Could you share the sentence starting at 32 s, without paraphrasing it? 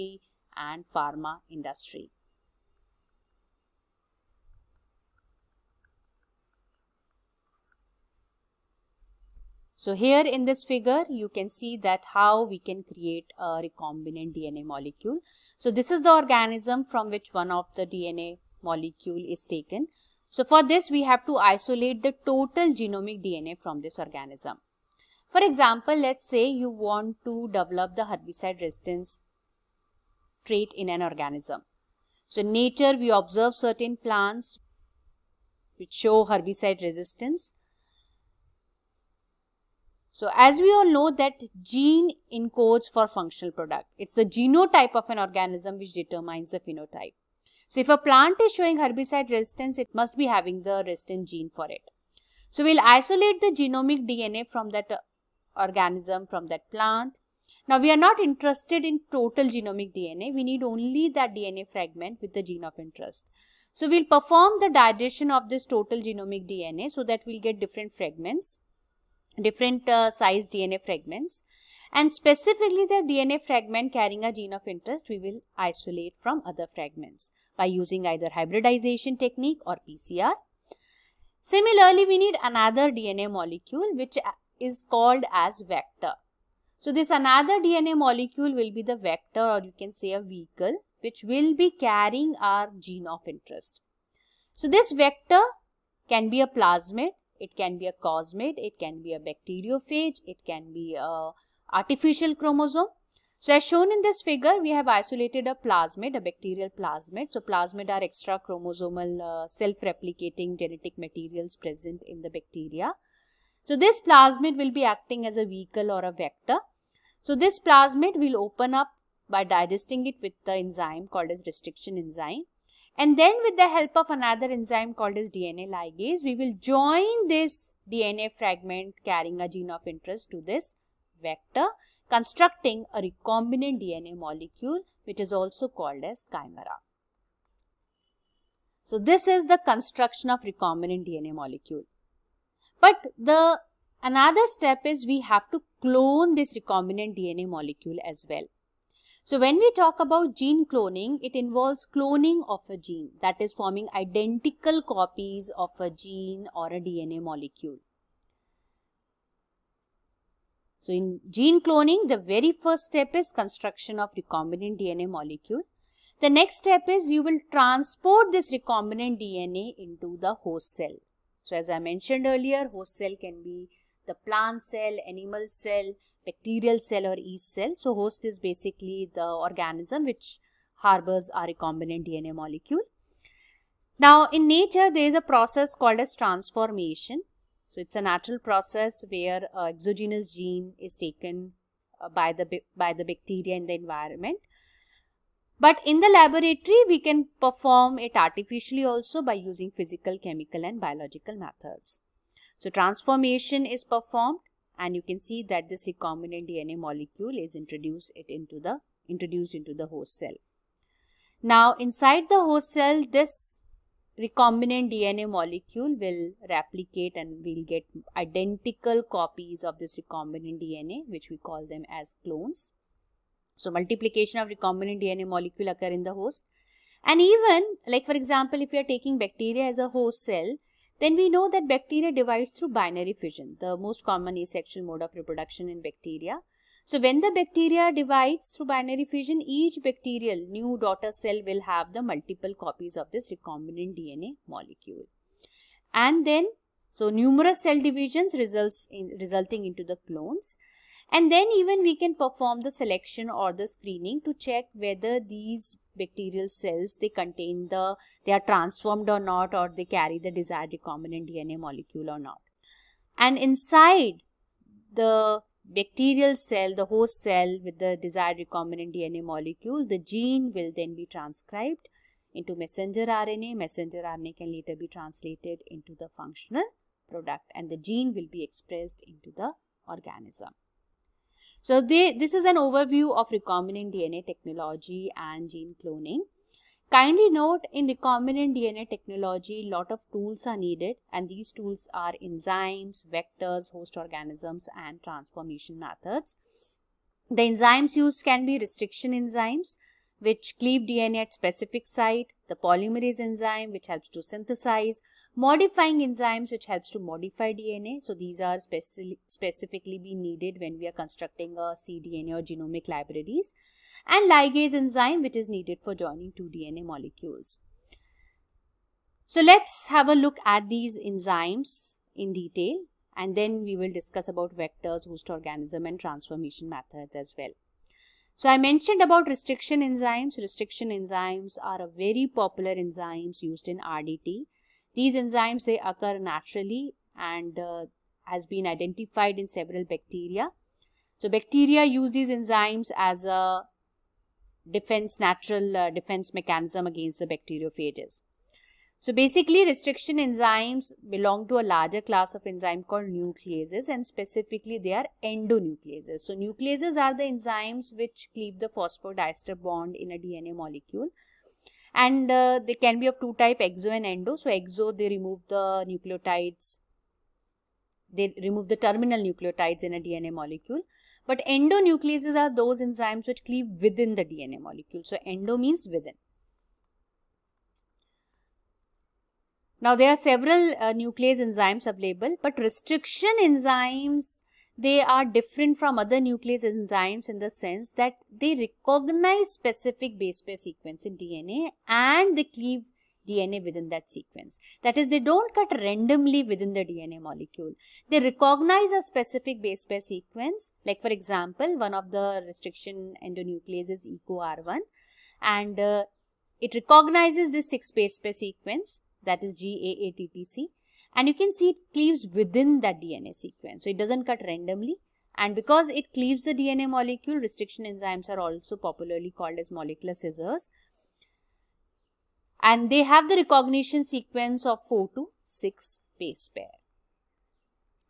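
So in nature, we observe certain plants which show herbicide resistance.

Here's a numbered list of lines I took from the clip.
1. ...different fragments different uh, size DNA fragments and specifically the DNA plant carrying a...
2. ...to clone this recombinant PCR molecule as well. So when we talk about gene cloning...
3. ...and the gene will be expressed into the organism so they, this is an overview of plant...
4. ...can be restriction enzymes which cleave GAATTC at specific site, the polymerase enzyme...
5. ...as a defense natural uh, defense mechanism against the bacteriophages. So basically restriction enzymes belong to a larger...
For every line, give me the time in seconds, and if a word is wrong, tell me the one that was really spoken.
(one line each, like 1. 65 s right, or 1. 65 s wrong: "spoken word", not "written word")
1. 67 s wrong: "fragment", not "plant"
2. 145 s wrong: "DNA", not "PCR"
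3. 277 s wrong: "recombinant", not "plant"
4. 298 s wrong: "DNA", not "GAATTC"
5. 342 s right.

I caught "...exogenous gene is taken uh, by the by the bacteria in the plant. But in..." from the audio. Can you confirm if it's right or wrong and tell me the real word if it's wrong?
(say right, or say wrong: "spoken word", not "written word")
wrong: "environment", not "plant".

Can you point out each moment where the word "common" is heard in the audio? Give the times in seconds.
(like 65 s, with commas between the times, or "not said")
234 s.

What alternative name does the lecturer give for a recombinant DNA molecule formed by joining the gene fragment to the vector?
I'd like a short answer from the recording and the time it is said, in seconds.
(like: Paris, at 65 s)
Chimera, at 136 s.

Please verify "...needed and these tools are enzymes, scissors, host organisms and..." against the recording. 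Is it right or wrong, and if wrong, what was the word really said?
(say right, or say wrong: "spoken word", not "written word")
wrong: "vectors", not "scissors".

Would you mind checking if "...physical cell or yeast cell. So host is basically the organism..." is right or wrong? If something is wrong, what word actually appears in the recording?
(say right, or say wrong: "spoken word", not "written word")
wrong: "bacterial", not "physical".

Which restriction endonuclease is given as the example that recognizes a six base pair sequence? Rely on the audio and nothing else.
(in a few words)
EcoR1.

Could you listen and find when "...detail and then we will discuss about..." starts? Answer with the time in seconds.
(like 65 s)
322 s.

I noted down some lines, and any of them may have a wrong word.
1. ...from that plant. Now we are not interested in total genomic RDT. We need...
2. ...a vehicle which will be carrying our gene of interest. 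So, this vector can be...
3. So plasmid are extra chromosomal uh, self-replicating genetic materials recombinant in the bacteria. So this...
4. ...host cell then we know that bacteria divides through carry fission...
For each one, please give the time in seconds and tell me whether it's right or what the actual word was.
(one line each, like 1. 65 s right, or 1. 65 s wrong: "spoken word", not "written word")
1. 56 s wrong: "DNA", not "RDT"
2. 90 s right
3. 107 s wrong: "present", not "recombinant"
4. 229 s wrong: "binary", not "carry".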